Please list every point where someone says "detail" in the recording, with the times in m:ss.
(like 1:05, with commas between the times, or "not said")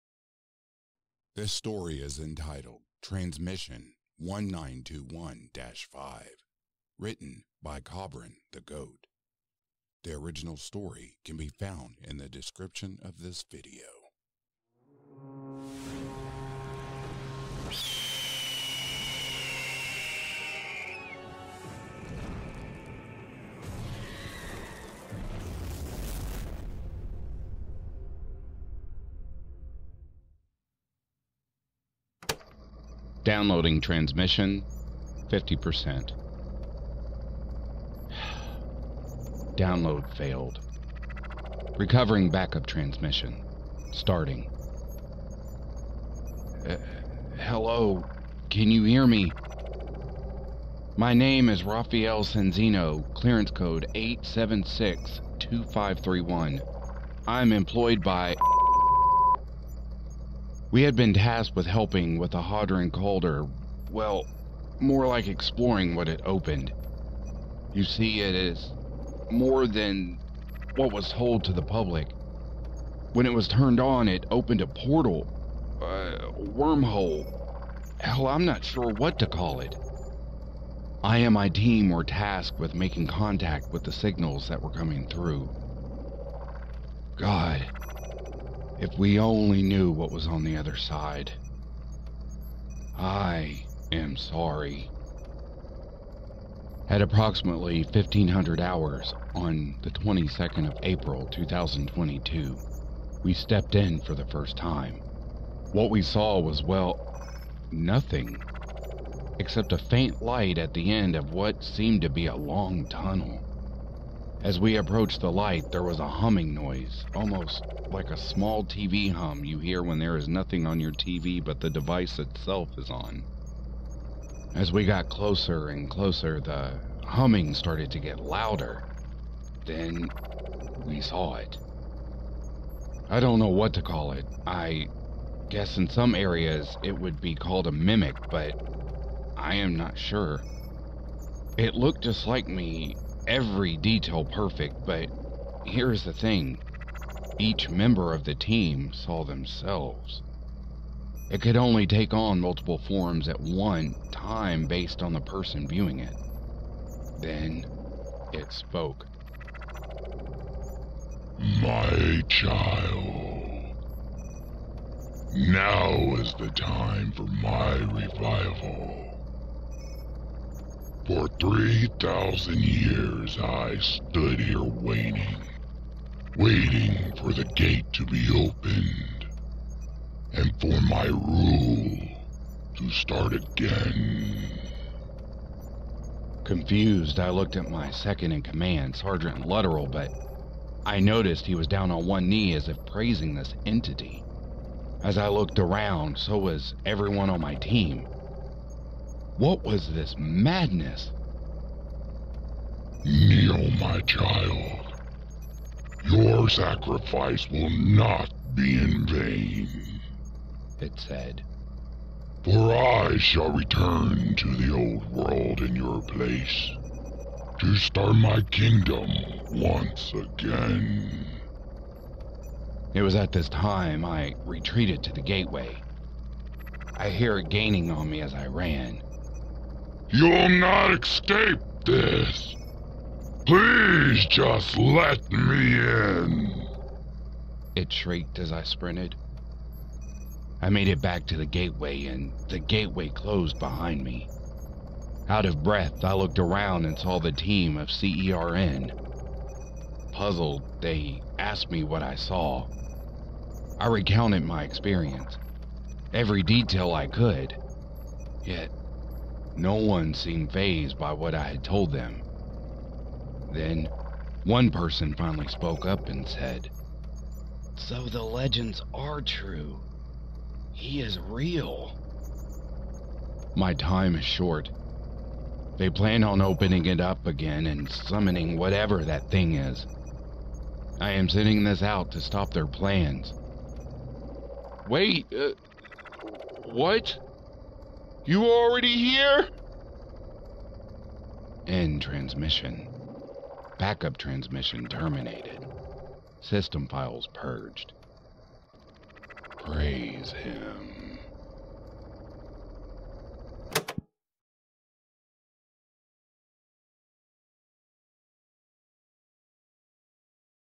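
2:23, 4:16.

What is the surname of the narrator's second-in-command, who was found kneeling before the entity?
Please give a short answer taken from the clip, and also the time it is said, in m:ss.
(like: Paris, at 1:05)
Lutterell, at 3:08.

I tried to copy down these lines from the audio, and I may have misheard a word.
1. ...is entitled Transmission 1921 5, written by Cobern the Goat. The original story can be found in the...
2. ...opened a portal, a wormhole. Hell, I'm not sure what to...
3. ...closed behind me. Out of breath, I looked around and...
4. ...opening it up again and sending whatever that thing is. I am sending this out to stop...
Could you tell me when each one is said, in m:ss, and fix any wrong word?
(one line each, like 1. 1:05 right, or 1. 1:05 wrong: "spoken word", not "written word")
1. 0:02 right
2. 1:14 right
3. 4:03 right
4. 4:36 wrong: "summoning", not "sending".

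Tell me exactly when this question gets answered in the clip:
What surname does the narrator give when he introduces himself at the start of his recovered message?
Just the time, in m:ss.
0:51.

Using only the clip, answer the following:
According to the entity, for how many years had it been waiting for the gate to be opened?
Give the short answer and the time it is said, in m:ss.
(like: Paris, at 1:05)
3,000, at 2:51.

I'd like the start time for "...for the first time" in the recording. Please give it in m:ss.
1:43.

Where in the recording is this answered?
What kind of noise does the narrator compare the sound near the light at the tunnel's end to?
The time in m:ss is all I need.
1:58.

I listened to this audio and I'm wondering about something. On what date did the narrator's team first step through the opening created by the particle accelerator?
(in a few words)
22 April 2022.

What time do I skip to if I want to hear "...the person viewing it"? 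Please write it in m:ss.
2:35.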